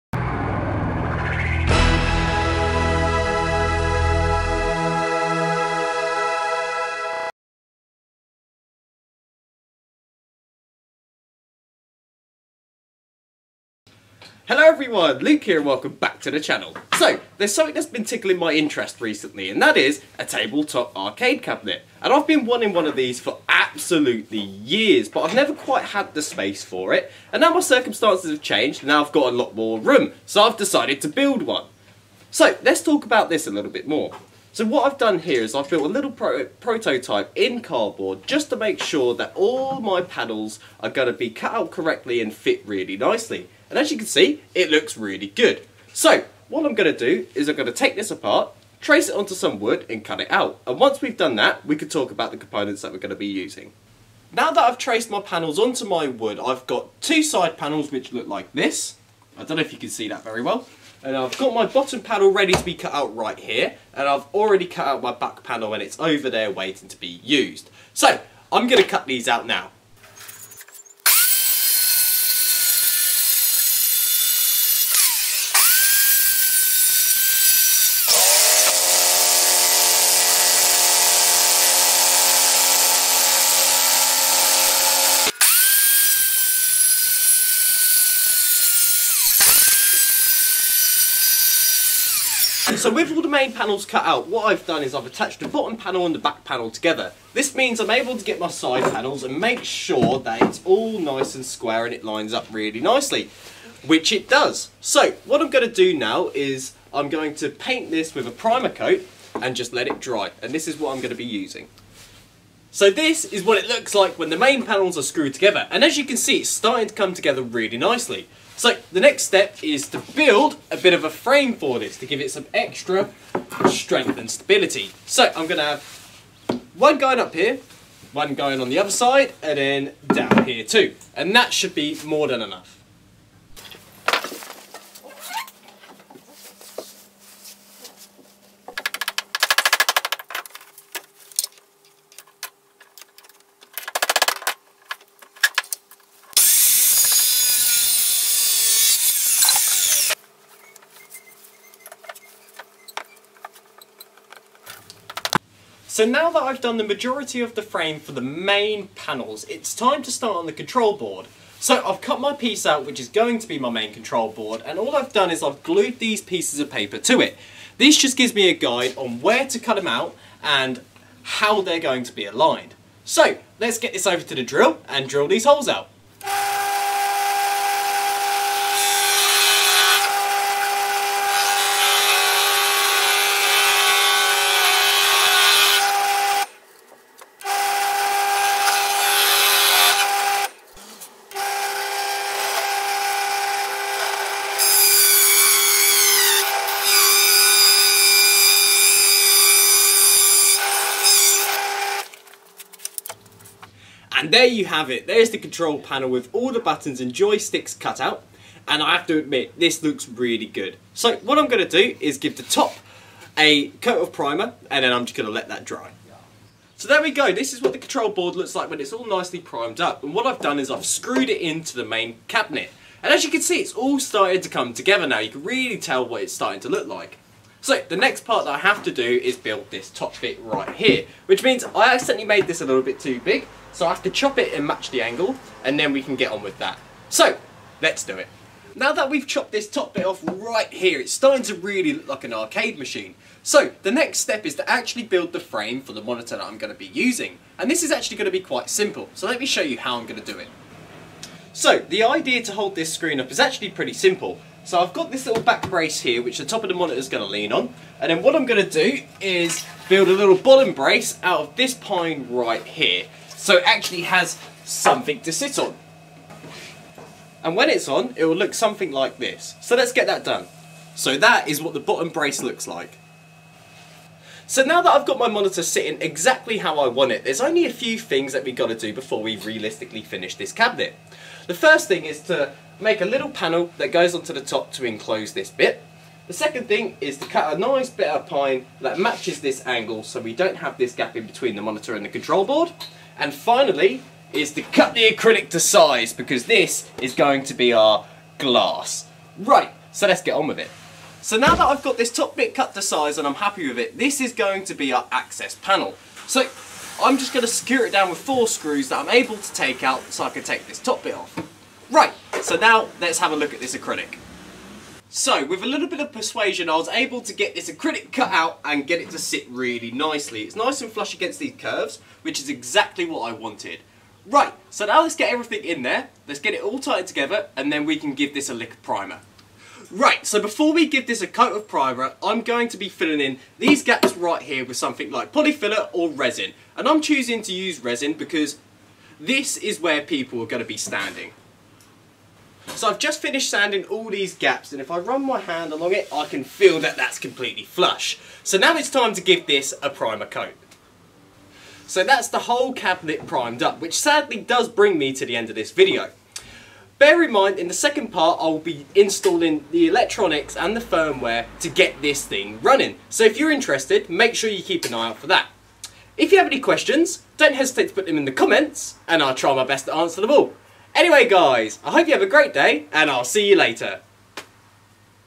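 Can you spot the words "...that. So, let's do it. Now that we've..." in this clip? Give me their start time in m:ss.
3:56.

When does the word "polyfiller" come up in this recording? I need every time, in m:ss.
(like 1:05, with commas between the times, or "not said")
5:35.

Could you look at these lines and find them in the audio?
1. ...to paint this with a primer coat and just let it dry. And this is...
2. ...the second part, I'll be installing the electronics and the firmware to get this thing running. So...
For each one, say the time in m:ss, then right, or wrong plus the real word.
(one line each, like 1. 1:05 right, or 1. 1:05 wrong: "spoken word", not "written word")
1. 1:47 right
2. 5:57 right.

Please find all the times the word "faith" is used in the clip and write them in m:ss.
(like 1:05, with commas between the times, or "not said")
not said.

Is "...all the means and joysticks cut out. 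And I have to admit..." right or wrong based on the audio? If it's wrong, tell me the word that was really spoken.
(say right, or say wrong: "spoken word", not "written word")
wrong: "buttons", not "means".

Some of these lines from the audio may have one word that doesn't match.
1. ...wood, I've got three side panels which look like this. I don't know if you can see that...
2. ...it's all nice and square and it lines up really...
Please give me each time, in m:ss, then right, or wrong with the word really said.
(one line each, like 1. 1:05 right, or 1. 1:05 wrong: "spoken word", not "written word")
1. 0:56 wrong: "two", not "three"
2. 1:40 right.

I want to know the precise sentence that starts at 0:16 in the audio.
So, there's something that's been tickling my interest recently and that is a tabletop arcade cabinet.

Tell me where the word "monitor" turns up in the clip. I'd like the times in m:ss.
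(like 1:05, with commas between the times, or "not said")
4:06, 4:16, 4:35, 4:51.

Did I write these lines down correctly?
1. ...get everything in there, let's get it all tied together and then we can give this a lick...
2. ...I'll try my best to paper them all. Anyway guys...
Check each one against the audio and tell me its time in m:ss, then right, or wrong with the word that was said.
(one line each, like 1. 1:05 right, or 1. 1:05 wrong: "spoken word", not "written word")
1. 5:25 right
2. 6:09 wrong: "answer", not "paper".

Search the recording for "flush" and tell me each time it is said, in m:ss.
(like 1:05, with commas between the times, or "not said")
5:20, 5:47.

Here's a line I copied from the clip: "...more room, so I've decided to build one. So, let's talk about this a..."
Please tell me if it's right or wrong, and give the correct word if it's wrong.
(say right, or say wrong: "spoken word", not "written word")
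right.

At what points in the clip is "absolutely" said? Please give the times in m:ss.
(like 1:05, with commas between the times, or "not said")
0:23.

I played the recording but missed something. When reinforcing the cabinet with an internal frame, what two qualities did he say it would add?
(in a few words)
strength and stability.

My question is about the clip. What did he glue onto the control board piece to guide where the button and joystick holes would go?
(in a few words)
pieces of paper.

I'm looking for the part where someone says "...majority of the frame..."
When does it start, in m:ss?
2:36.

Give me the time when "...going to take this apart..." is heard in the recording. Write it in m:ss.
0:47.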